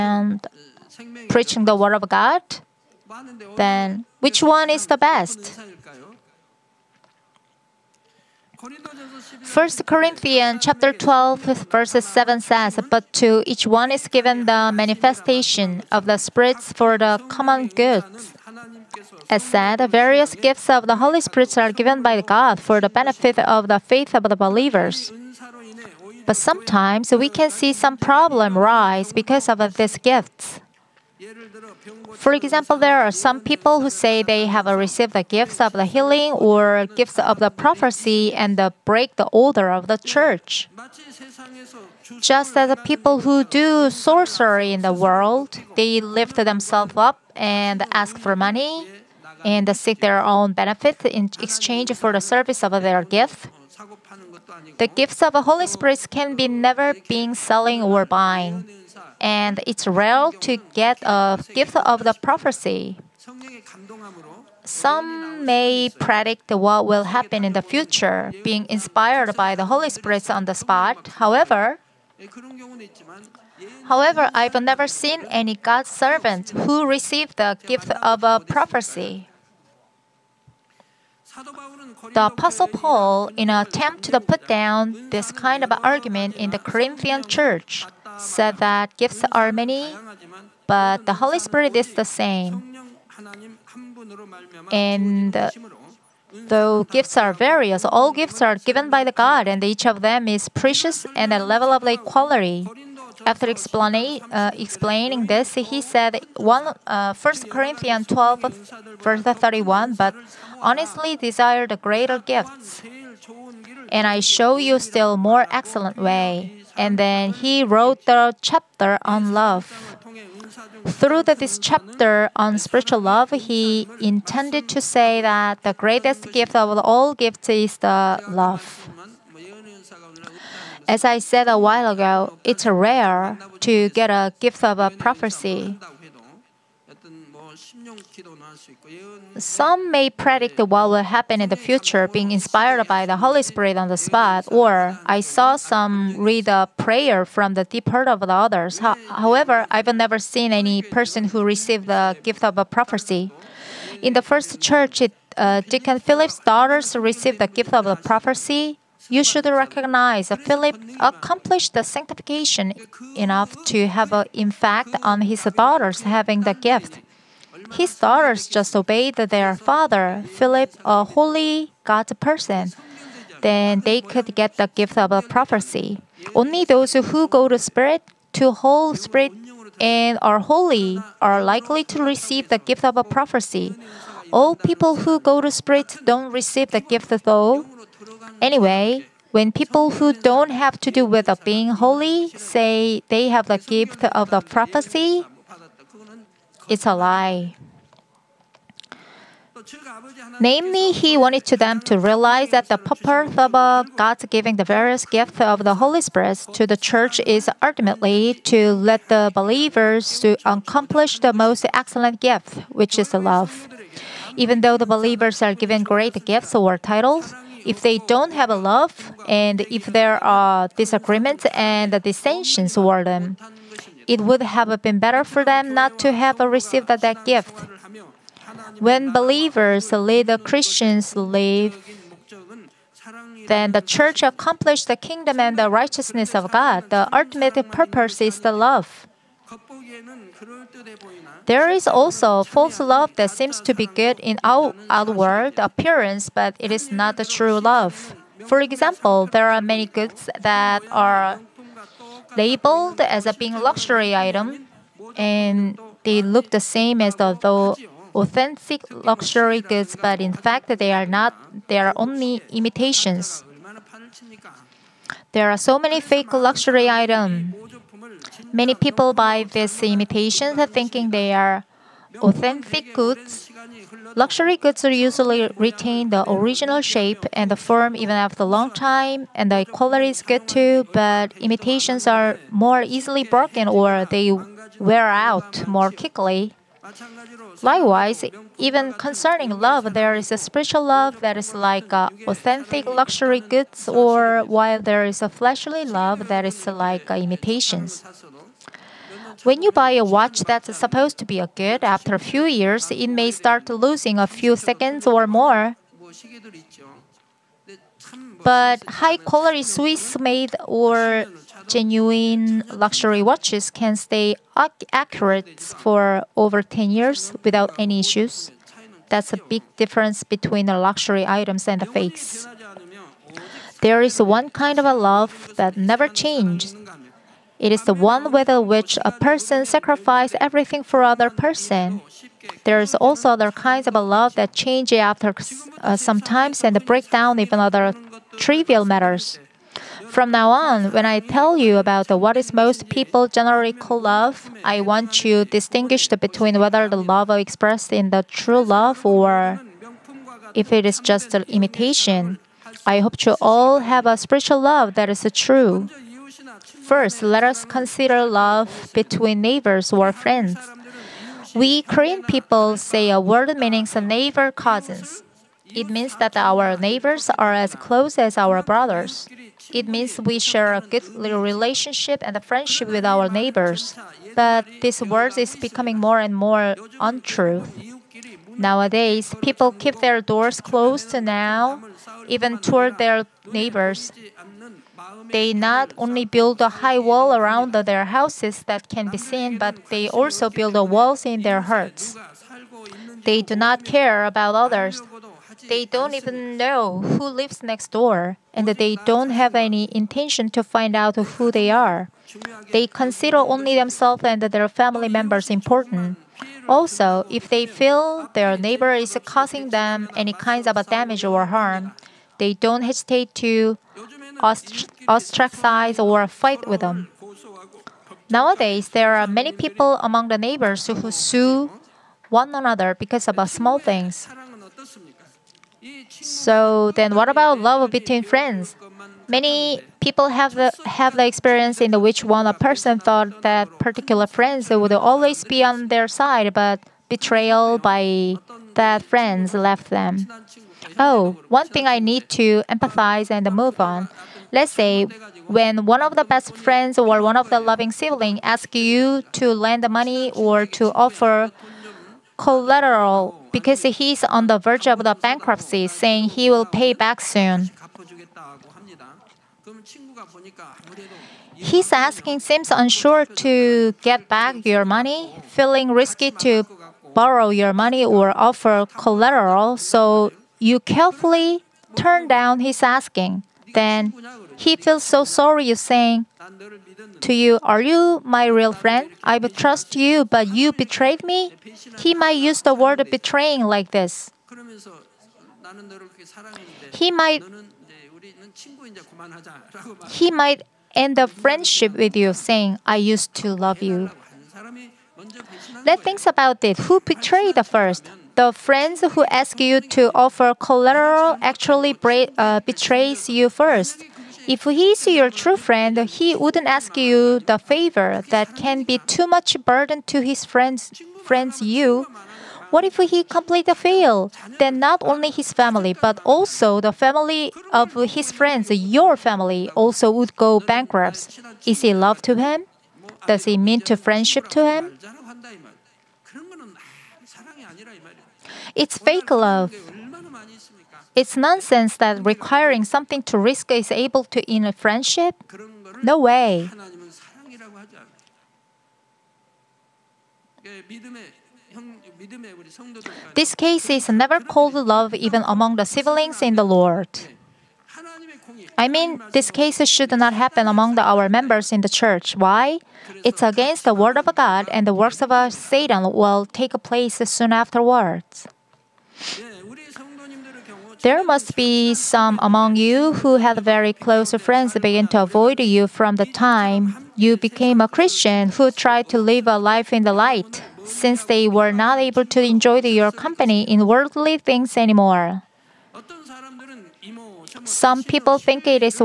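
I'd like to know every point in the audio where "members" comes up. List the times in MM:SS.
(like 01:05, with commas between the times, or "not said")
06:45, 09:11.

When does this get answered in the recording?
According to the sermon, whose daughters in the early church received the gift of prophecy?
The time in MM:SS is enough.
02:35.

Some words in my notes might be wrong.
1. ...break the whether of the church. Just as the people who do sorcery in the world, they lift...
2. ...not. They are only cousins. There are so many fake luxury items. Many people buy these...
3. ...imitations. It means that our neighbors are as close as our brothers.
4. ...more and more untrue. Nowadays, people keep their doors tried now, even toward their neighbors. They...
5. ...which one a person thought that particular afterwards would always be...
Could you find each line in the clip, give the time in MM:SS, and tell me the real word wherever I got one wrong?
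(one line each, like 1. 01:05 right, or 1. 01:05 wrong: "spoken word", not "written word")
1. 00:38 wrong: "order", not "whether"
2. 04:21 wrong: "imitations", not "cousins"
3. 06:04 wrong: "cousins", not "imitations"
4. 06:15 wrong: "closed", not "tried"
5. 07:12 wrong: "friends", not "afterwards".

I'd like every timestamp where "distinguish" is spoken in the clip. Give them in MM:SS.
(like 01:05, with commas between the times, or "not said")
05:45.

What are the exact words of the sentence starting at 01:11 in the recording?
However, However, I've never seen any God's servant who received the gift of a prophecy.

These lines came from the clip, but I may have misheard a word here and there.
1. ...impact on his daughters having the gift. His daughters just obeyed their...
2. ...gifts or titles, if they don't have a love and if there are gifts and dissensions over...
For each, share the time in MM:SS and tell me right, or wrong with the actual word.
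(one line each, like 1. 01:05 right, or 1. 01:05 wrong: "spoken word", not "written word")
1. 02:44 right
2. 03:36 wrong: "disagreements", not "gifts".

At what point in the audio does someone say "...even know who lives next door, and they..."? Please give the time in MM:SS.
06:36.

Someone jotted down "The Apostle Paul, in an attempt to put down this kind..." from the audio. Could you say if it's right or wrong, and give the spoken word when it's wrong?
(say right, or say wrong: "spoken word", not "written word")
right.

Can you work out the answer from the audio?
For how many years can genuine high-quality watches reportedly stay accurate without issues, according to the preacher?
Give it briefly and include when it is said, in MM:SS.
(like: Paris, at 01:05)
Over 10 years, at 05:16.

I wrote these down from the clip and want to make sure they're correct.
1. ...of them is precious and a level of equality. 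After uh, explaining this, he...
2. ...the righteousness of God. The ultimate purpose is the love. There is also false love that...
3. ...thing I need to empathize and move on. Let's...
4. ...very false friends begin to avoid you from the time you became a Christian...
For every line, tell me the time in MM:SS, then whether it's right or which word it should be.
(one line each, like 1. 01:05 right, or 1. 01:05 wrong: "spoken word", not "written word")
1. 01:39 right
2. 03:55 right
3. 07:21 right
4. 09:23 wrong: "close", not "false".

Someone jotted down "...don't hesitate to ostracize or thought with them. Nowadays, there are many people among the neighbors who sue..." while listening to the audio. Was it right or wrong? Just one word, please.
wrong.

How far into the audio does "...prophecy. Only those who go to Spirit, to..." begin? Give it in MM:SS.
02:55.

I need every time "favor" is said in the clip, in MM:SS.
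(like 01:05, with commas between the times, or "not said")
08:27.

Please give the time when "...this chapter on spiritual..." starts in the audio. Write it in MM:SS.
02:01.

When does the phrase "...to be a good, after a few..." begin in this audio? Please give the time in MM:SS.
05:01.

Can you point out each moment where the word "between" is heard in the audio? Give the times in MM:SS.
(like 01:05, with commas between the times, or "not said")
05:20, 05:46, 05:58, 07:07.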